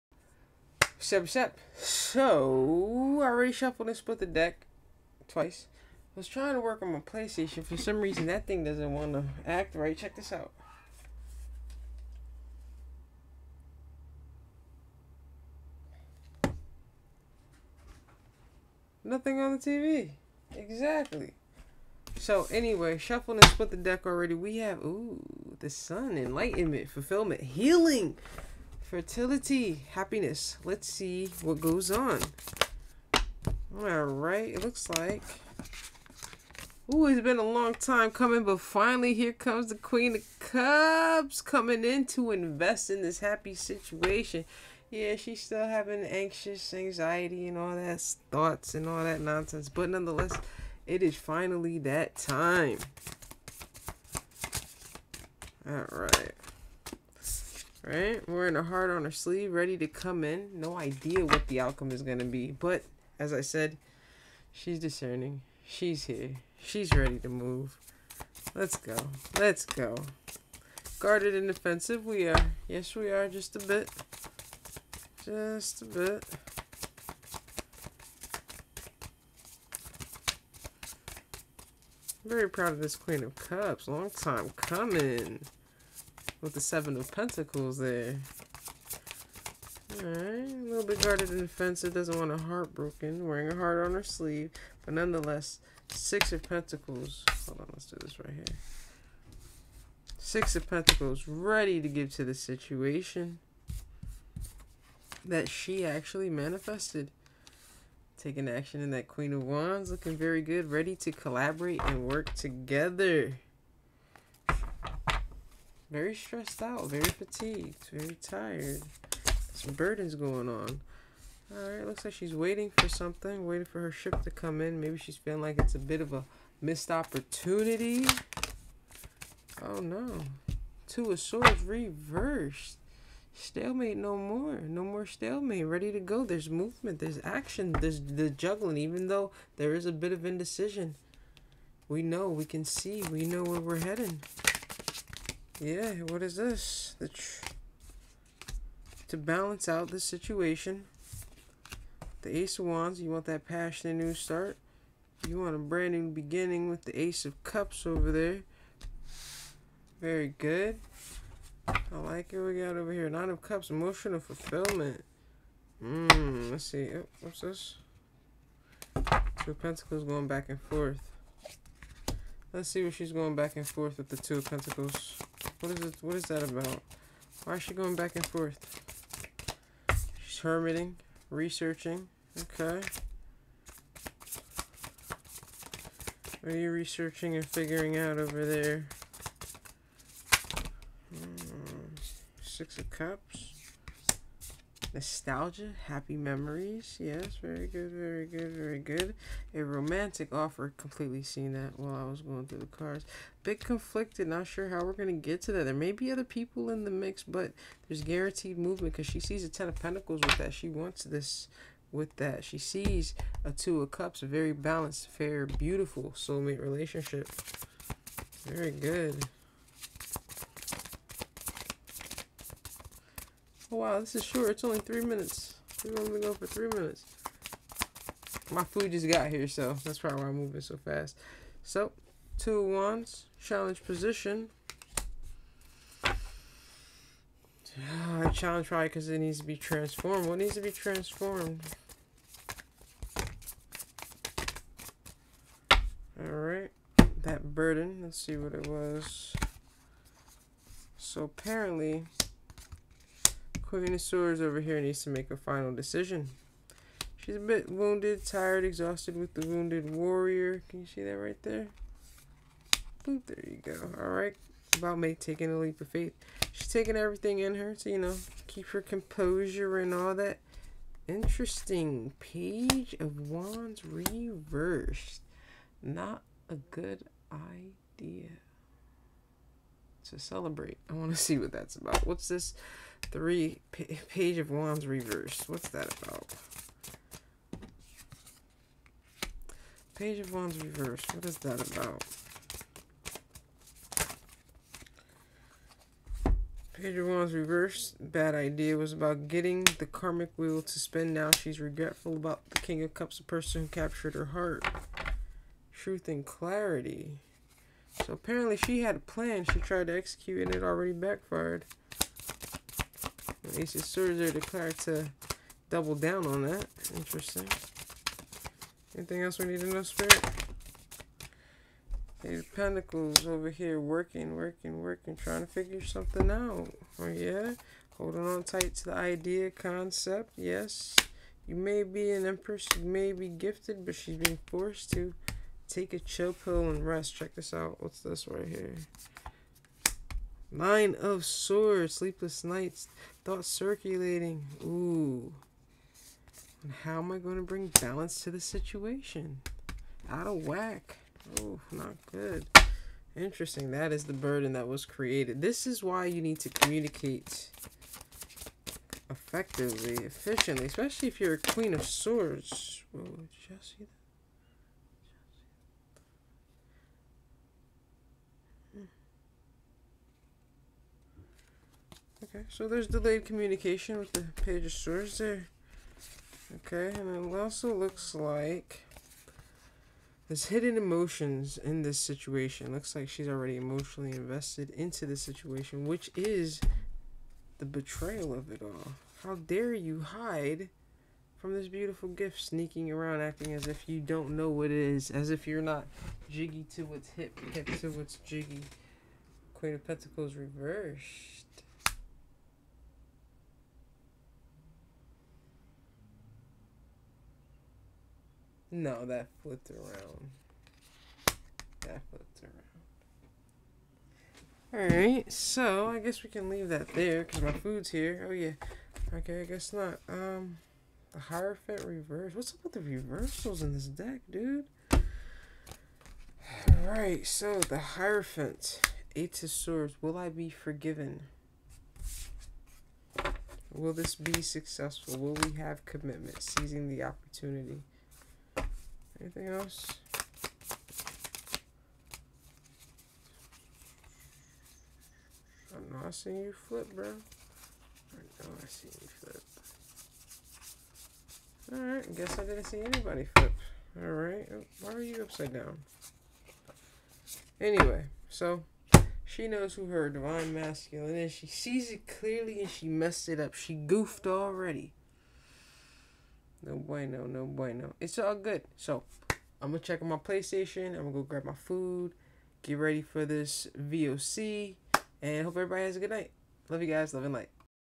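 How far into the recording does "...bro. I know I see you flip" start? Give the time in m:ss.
7:26.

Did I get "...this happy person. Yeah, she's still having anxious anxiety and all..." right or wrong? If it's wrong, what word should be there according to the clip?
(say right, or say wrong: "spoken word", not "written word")
wrong: "situation", not "person".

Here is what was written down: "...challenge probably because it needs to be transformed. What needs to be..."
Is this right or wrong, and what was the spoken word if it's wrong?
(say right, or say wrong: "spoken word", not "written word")
right.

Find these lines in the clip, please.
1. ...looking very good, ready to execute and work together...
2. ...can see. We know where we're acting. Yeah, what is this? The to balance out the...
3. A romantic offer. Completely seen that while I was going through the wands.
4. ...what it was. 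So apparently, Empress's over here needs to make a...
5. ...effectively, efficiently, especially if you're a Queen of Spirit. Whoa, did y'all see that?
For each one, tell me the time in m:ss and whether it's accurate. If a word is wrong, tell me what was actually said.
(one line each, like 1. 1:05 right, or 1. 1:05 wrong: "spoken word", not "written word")
1. 1:49 wrong: "collaborate", not "execute"
2. 2:22 wrong: "heading", not "acting"
3. 3:19 wrong: "cards", not "wands"
4. 4:08 wrong: "Quirunosaur", not "Empress"
5. 5:59 wrong: "Swords", not "Spirit".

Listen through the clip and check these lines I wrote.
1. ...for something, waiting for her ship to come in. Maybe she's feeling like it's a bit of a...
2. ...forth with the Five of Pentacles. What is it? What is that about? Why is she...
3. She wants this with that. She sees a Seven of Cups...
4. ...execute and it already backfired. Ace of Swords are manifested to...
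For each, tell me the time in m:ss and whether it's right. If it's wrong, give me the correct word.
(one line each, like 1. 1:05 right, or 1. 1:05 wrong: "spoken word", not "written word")
1. 2:02 right
2. 2:53 wrong: "Two", not "Five"
3. 3:30 wrong: "Two", not "Seven"
4. 5:09 wrong: "declared", not "manifested".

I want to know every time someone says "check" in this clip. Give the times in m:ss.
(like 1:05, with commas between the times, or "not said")
0:09, 5:37, 7:49.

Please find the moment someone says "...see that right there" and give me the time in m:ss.
4:20.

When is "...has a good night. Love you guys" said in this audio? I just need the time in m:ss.
7:55.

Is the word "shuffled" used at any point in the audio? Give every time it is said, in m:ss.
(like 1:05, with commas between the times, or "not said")
0:03, 0:22.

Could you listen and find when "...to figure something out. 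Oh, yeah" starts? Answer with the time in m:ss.
5:25.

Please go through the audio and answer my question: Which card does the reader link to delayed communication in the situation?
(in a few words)
Page of Swords.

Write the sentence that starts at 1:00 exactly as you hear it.
No idea what the outcome is going to be.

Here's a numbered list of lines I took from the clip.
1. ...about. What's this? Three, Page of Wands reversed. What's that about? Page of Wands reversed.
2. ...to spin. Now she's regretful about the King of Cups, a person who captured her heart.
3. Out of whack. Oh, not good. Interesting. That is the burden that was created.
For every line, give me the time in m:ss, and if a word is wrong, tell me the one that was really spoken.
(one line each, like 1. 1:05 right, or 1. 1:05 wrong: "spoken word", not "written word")
1. 4:41 right
2. 5:00 right
3. 5:50 right.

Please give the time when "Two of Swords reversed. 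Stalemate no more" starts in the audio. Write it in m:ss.
2:10.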